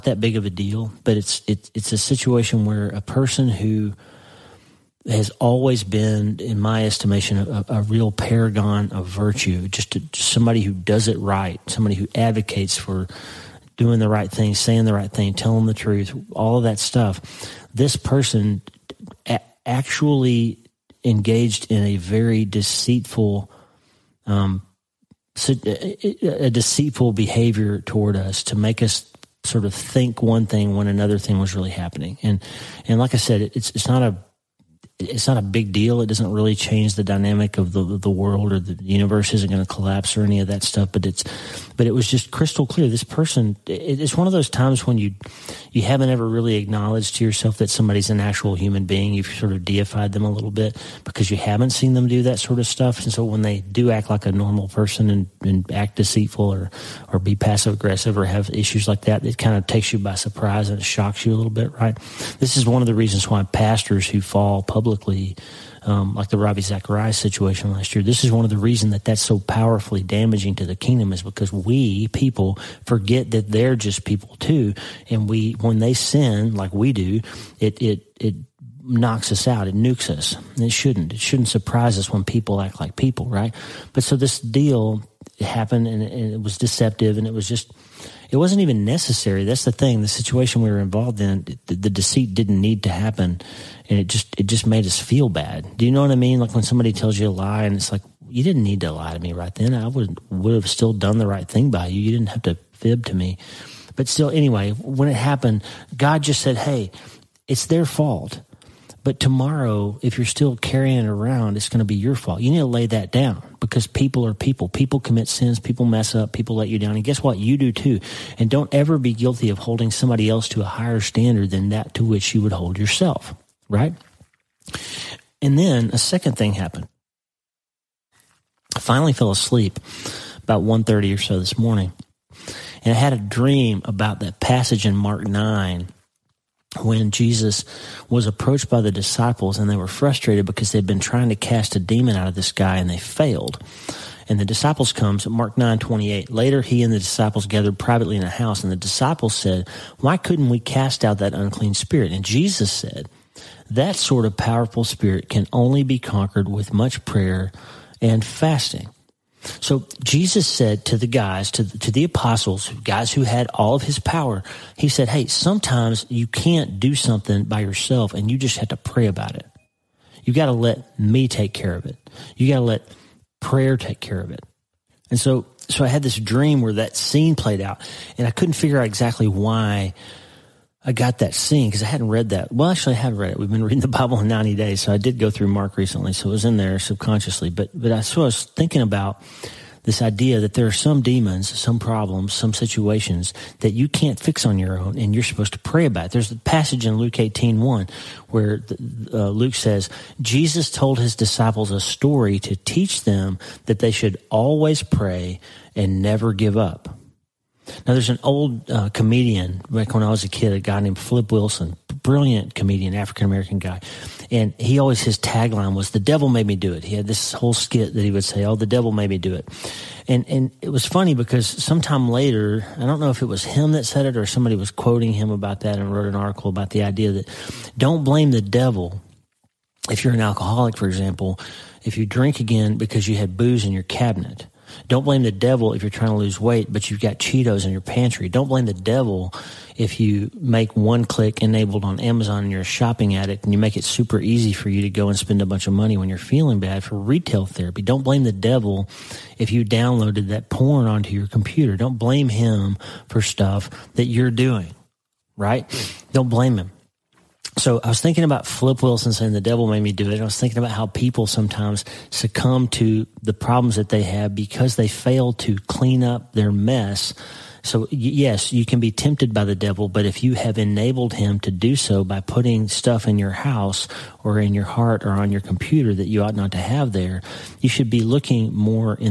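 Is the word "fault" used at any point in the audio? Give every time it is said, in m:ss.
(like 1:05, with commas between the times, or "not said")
1:47, 1:52.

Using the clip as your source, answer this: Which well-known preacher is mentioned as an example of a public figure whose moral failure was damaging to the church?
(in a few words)
Ravi Zacharias.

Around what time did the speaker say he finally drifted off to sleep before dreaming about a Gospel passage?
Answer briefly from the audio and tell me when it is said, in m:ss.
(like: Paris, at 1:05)
1:30, at 2:10.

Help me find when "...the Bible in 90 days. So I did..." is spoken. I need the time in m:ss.
3:03.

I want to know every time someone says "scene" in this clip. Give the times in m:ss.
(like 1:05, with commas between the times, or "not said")
2:56, 3:01.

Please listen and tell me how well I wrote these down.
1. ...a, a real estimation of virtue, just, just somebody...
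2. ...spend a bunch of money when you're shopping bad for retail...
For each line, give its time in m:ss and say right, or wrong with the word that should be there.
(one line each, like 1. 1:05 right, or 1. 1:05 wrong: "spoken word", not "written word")
1. 0:07 wrong: "paragon", not "estimation"
2. 4:05 wrong: "feeling", not "shopping".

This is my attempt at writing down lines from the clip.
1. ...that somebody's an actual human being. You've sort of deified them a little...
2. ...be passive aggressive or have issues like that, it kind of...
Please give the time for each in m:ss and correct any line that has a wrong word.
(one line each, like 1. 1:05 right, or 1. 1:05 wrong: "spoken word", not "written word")
1. 0:47 right
2. 0:57 right.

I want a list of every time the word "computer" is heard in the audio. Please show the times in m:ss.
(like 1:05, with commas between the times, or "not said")
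4:11, 4:35.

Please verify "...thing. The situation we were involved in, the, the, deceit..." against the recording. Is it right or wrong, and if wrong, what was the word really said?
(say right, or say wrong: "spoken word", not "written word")
right.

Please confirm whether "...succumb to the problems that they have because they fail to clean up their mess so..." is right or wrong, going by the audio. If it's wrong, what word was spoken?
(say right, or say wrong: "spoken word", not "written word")
right.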